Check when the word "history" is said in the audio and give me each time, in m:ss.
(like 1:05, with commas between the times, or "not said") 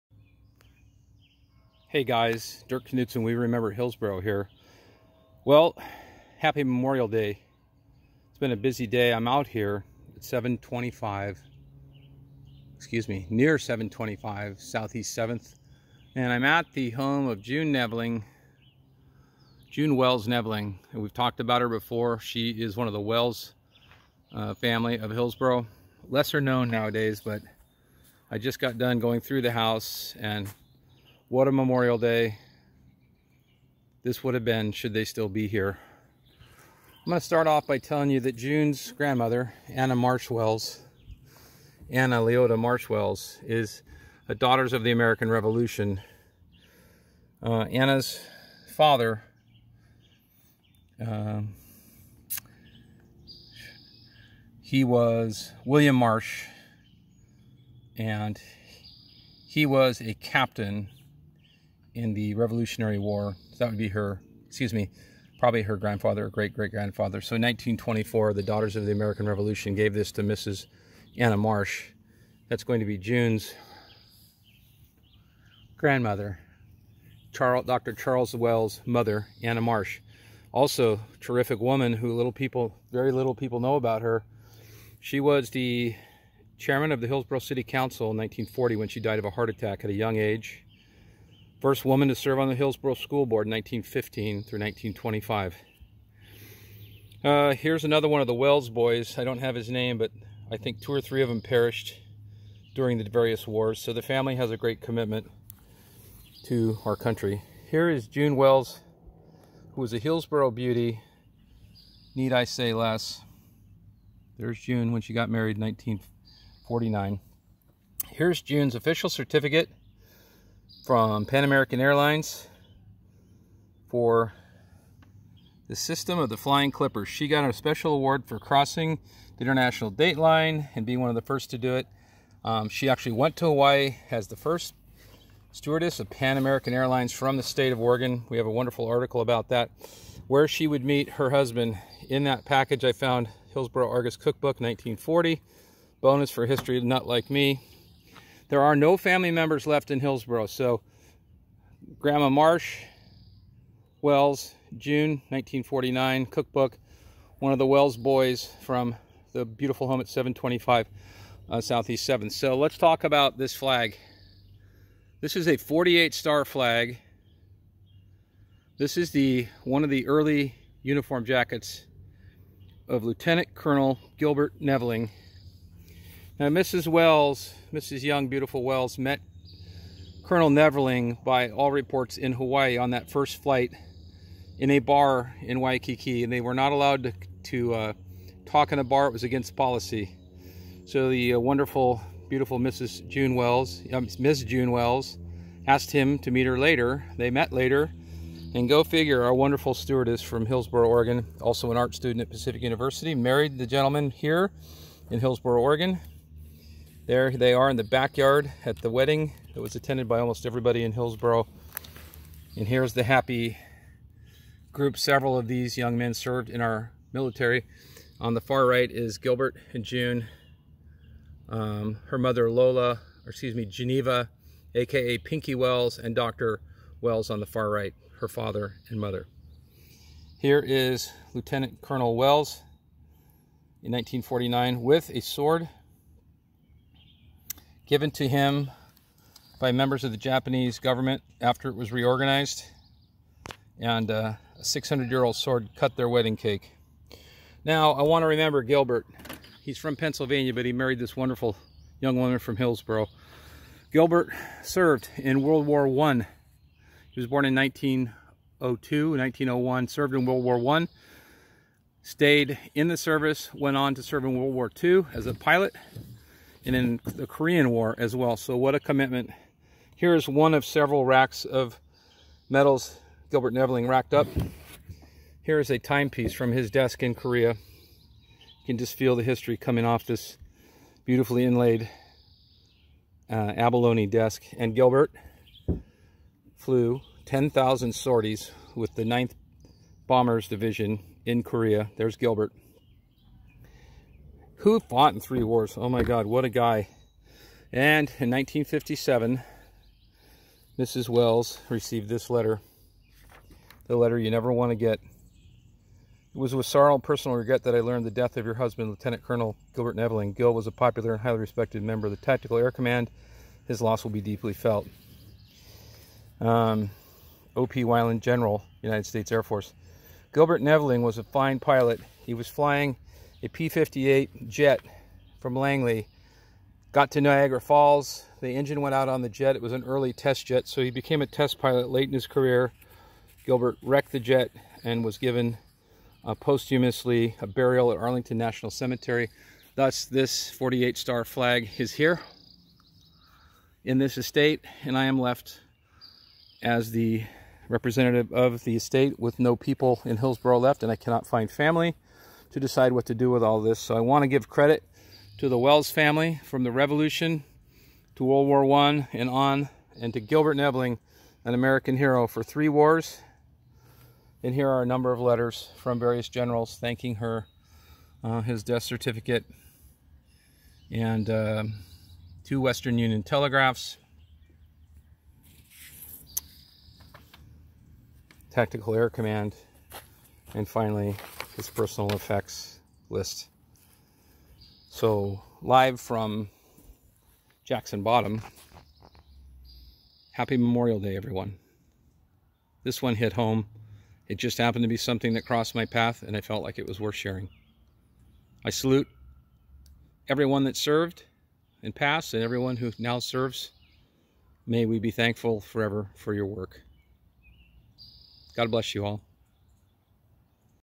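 2:26, 4:39.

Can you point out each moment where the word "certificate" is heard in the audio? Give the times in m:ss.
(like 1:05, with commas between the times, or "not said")
1:59, 6:08.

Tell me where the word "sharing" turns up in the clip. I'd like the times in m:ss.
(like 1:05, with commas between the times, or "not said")
6:37.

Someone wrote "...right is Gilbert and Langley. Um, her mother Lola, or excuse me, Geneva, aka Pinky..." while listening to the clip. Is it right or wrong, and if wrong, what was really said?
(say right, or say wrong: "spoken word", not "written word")
wrong: "June", not "Langley".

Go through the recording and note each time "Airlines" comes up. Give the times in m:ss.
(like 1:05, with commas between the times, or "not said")
2:01, 2:16.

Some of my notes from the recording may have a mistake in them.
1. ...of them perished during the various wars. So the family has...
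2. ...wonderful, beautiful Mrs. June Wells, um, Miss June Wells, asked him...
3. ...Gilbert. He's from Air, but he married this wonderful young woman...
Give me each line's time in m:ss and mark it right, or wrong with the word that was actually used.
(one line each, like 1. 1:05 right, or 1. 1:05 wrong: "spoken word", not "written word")
1. 1:41 right
2. 3:11 right
3. 4:08 wrong: "Pennsylvania", not "Air".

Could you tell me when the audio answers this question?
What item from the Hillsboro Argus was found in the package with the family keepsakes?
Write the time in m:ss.
2:24.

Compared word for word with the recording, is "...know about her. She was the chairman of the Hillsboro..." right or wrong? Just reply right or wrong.
right.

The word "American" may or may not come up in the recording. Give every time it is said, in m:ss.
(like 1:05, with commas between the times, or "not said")
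0:44, 1:08, 2:01, 2:16, 6:01.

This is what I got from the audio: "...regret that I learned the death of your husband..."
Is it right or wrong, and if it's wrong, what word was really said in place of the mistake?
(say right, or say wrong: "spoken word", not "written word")
right.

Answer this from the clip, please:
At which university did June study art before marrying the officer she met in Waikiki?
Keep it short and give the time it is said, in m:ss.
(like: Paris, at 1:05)
Pacific University, at 3:22.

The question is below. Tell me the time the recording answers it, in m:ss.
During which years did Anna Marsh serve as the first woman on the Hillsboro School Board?
1:33.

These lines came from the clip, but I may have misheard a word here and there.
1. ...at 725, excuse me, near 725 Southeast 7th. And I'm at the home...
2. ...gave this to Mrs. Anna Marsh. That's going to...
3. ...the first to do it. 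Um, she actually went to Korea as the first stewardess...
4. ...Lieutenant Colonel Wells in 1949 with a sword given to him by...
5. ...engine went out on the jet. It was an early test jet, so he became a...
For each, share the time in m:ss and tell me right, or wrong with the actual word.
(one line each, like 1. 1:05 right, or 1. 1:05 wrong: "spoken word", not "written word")
1. 0:10 right
2. 1:09 right
3. 2:11 wrong: "Hawaii", not "Korea"
4. 3:51 right
5. 5:28 right.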